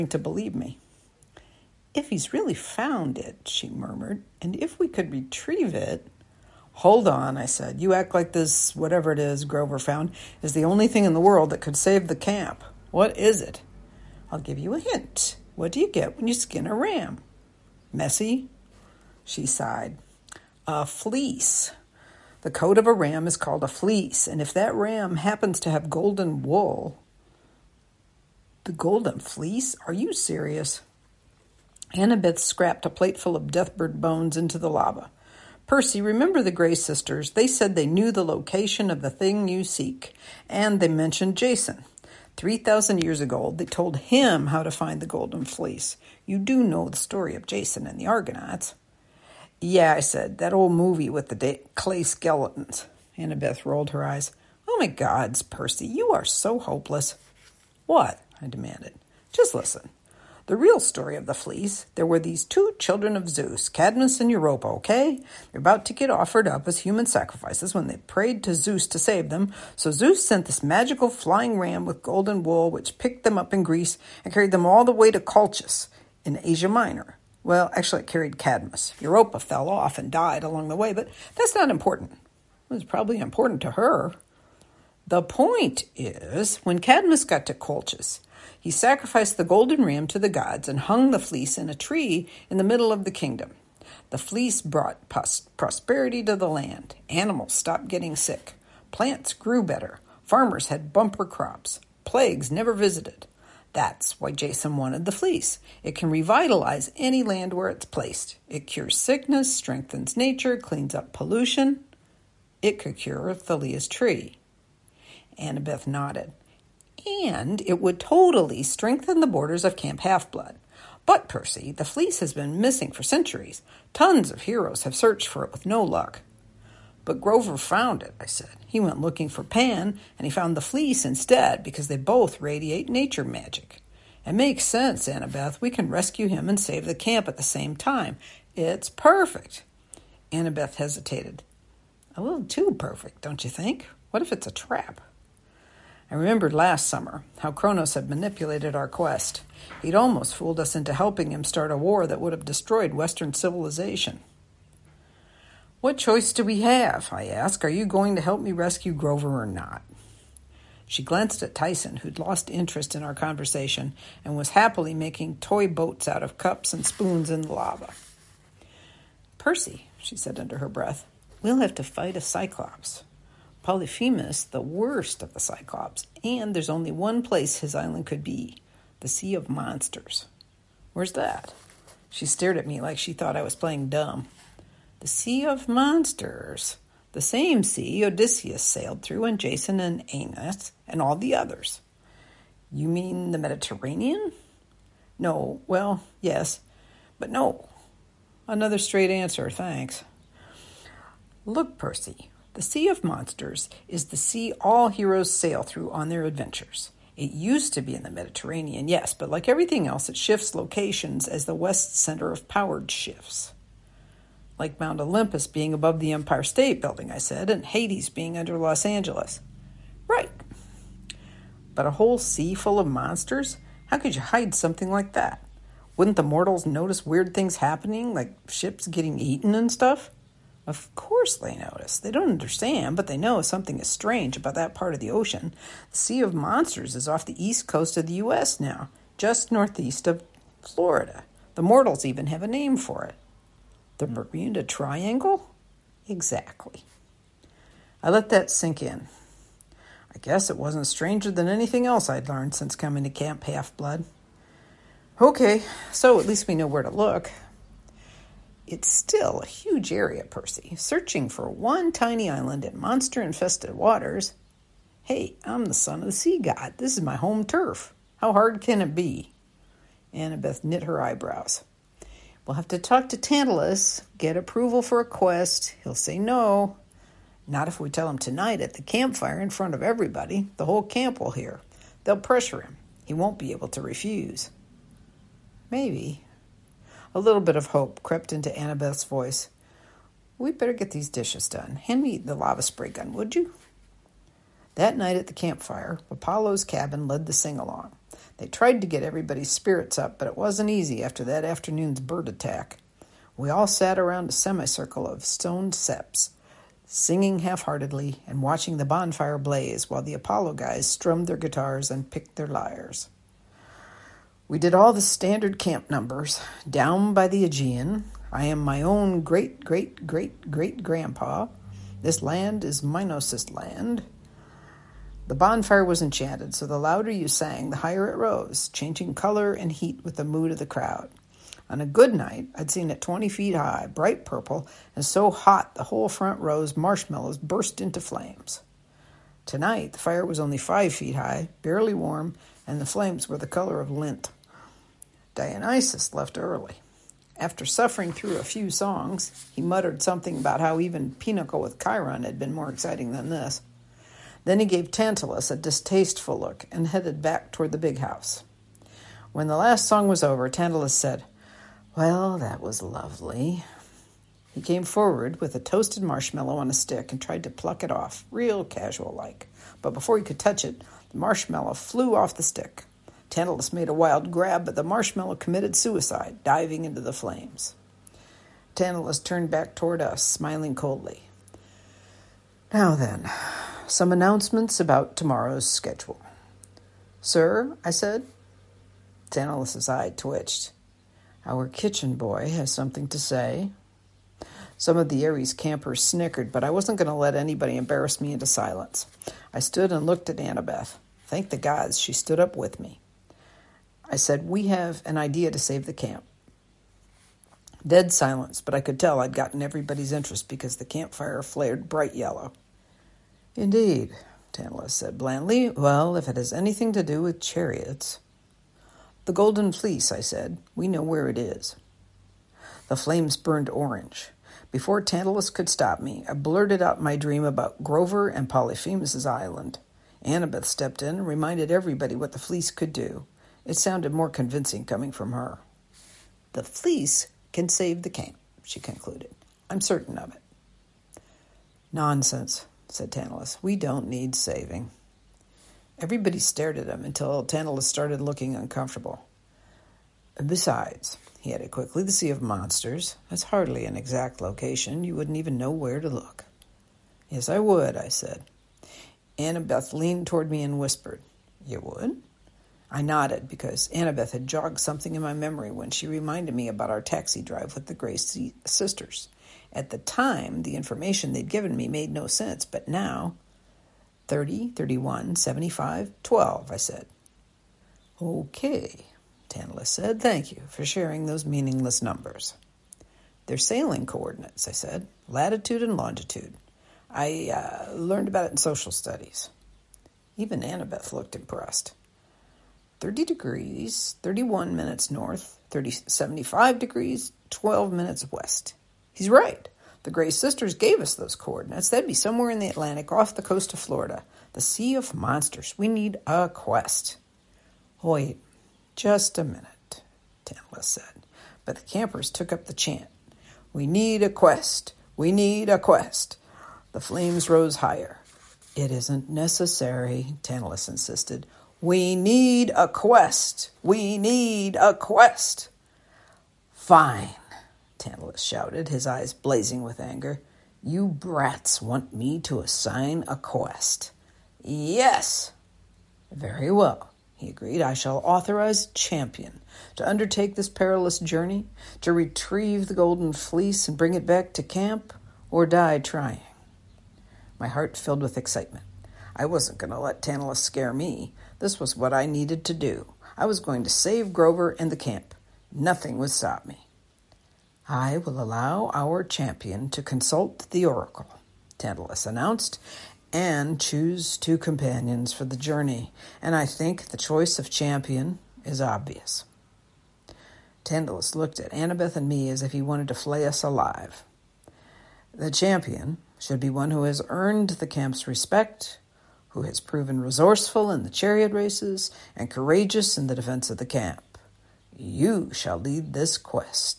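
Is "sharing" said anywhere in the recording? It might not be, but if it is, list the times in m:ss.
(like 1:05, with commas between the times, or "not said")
8:00.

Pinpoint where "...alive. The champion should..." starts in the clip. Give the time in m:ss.
9:33.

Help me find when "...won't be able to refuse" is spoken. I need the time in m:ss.
4:43.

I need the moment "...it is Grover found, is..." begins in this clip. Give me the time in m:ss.
0:09.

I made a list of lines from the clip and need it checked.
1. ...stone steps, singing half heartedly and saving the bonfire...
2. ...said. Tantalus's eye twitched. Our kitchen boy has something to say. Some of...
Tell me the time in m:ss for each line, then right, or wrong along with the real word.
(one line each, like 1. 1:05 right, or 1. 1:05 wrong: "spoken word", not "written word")
1. 5:05 wrong: "watching", not "saving"
2. 6:27 right.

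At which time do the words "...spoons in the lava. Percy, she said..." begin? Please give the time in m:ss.
2:46.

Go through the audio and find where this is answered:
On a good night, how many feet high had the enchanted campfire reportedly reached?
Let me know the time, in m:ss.
5:32.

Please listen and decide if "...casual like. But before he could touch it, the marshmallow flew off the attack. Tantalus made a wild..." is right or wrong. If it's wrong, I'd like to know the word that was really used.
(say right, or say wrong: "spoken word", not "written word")
wrong: "stick", not "attack".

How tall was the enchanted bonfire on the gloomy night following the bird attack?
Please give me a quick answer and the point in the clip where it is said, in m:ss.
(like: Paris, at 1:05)
5 feet, at 5:40.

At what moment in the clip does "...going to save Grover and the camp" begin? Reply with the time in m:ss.
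9:13.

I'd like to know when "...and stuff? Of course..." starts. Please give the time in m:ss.
3:49.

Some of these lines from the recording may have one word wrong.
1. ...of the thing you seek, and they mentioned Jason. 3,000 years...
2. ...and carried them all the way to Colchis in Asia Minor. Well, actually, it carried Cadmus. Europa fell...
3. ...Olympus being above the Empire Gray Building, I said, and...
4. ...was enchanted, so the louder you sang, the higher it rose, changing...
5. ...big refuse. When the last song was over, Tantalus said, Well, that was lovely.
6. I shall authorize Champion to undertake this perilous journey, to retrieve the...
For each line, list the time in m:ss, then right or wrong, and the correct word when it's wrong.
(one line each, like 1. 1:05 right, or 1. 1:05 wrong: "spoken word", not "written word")
1. 0:38 right
2. 1:14 right
3. 3:34 wrong: "State", not "Gray"
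4. 5:25 right
5. 5:57 wrong: "house", not "refuse"
6. 8:57 right.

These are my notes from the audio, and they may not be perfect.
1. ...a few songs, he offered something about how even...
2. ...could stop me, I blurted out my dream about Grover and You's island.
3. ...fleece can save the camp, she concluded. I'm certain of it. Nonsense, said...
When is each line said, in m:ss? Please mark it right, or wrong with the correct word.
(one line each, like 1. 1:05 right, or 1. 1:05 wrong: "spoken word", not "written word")
1. 5:48 wrong: "muttered", not "offered"
2. 7:05 wrong: "Polyphemus", not "You"
3. 7:16 right.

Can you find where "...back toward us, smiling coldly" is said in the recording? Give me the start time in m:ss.
6:19.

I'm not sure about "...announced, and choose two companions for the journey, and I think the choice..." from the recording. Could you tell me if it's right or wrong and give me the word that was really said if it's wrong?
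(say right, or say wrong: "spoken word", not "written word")
right.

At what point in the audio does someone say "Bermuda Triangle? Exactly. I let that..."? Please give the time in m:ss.
4:04.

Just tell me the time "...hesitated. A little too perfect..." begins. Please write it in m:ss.
2:20.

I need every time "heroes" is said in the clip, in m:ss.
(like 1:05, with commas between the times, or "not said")
2:04, 3:24.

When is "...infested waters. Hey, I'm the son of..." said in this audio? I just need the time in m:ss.
4:23.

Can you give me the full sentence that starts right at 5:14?
We did all the standard camp numbers down by the Aegean.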